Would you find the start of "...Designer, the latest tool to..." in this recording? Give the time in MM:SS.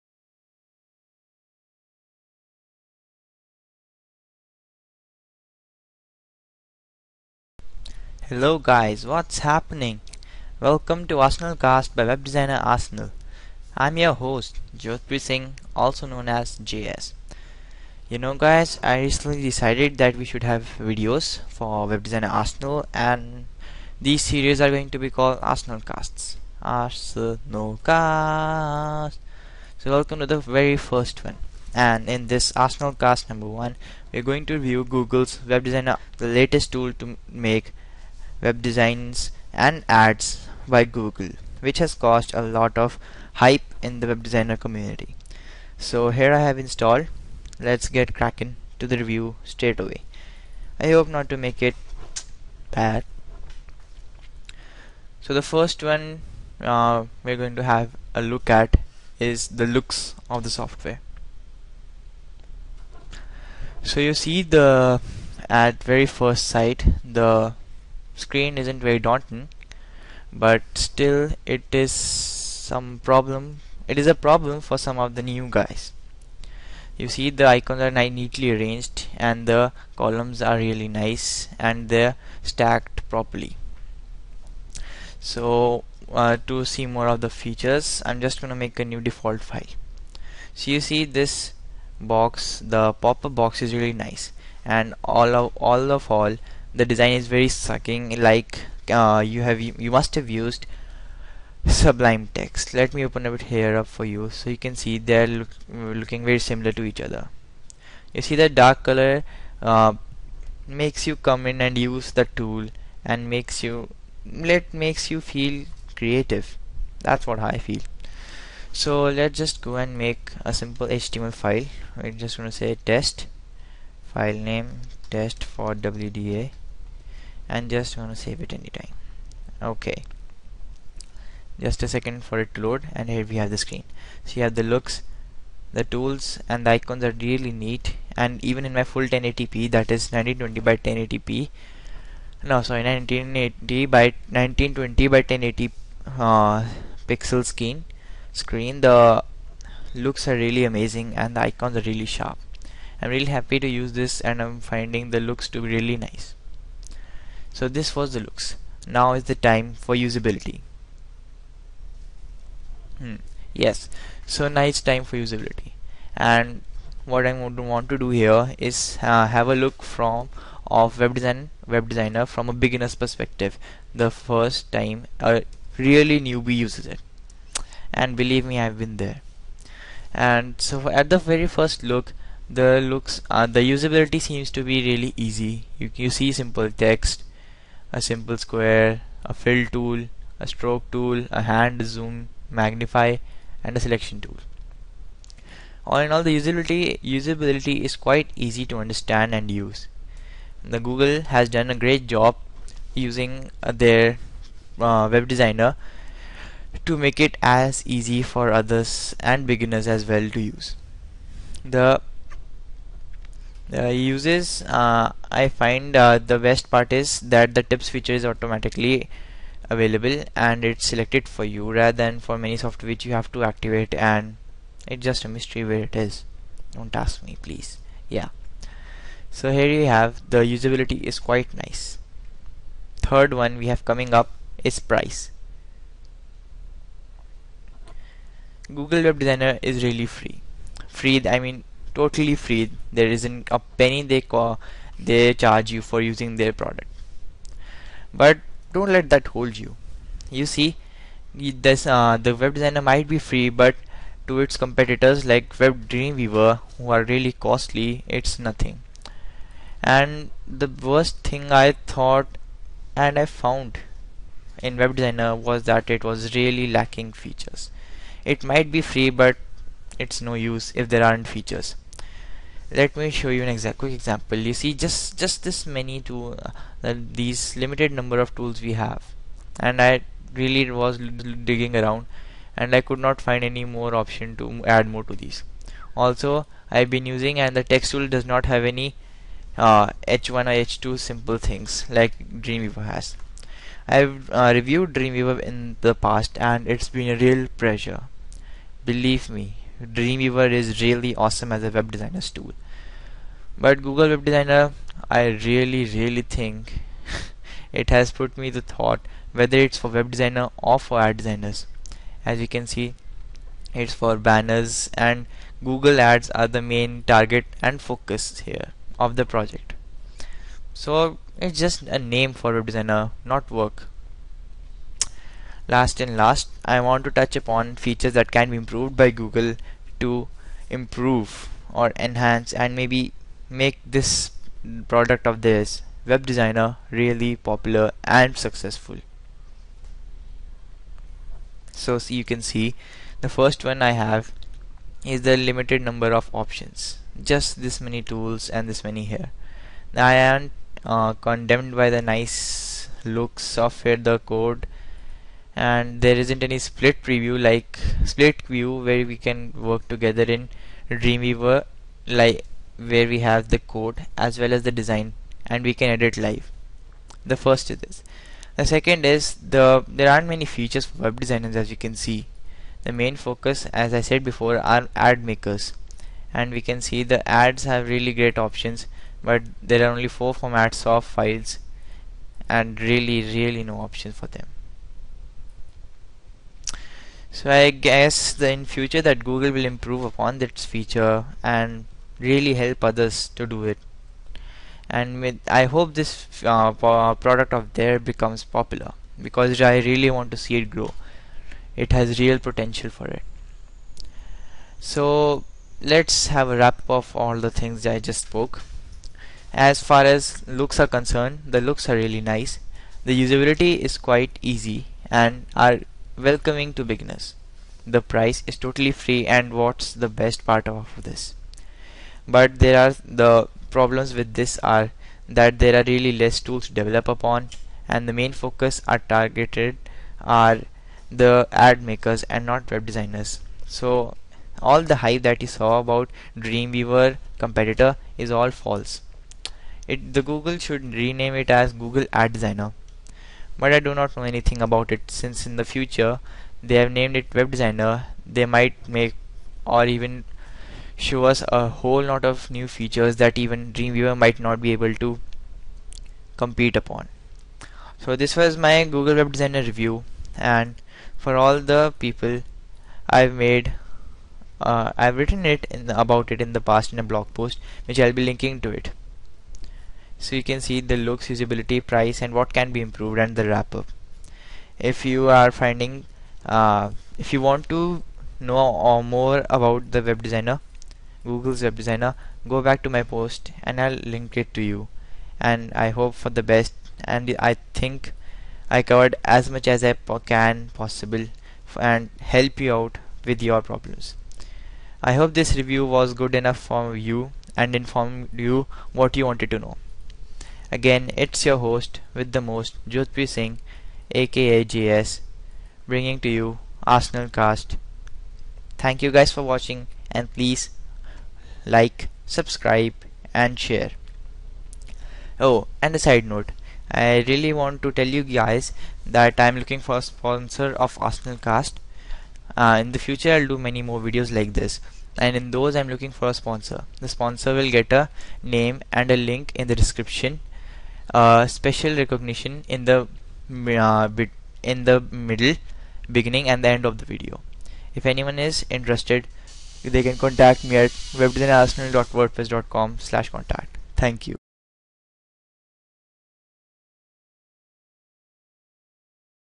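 00:35.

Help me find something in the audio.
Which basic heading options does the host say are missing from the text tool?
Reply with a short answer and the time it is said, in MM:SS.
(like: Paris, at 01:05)
h1 or h2, at 04:50.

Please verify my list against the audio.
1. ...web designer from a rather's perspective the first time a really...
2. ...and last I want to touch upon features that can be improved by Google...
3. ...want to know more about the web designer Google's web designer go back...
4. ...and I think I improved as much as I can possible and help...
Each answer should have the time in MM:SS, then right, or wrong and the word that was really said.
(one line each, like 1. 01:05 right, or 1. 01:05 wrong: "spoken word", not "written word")
1. 02:51 wrong: "beginner", not "rather"
2. 05:26 right
3. 07:57 right
4. 08:07 wrong: "covered", not "improved".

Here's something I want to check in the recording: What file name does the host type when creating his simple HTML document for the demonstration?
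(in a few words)
test for WDA.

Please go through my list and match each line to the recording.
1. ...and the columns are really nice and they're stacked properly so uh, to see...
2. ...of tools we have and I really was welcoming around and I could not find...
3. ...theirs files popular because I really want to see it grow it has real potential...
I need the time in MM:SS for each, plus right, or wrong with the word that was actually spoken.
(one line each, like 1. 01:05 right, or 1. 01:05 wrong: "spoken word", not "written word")
1. 01:19 right
2. 04:38 wrong: "digging", not "welcoming"
3. 06:37 wrong: "becomes", not "files".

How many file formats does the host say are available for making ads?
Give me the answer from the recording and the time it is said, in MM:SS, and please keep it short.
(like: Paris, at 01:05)
4, at 06:20.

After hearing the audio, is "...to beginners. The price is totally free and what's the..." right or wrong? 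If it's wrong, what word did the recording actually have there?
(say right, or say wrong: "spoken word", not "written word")
right.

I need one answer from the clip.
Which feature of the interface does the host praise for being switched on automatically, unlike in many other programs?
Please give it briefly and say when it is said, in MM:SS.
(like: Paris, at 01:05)
tips feature, at 03:37.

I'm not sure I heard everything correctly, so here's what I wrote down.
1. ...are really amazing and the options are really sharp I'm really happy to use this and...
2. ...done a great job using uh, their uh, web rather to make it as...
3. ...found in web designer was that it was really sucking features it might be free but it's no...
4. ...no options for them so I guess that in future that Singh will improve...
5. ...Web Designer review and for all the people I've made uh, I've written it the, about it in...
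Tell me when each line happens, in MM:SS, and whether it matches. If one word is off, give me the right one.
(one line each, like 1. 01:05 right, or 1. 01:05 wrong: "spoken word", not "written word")
1. 02:30 wrong: "icons", not "options"
2. 03:21 wrong: "designer", not "rather"
3. 04:23 wrong: "lacking", not "sucking"
4. 06:23 wrong: "Google", not "Singh"
5. 07:39 right.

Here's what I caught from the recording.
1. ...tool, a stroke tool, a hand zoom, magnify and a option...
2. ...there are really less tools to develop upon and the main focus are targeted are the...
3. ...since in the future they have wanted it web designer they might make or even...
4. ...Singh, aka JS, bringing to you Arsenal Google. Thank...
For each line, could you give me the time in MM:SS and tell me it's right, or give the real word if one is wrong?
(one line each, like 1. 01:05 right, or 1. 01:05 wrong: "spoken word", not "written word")
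1. 03:09 wrong: "selection", not "option"
2. 07:05 right
3. 07:25 wrong: "named", not "wanted"
4. 08:23 wrong: "Cast", not "Google".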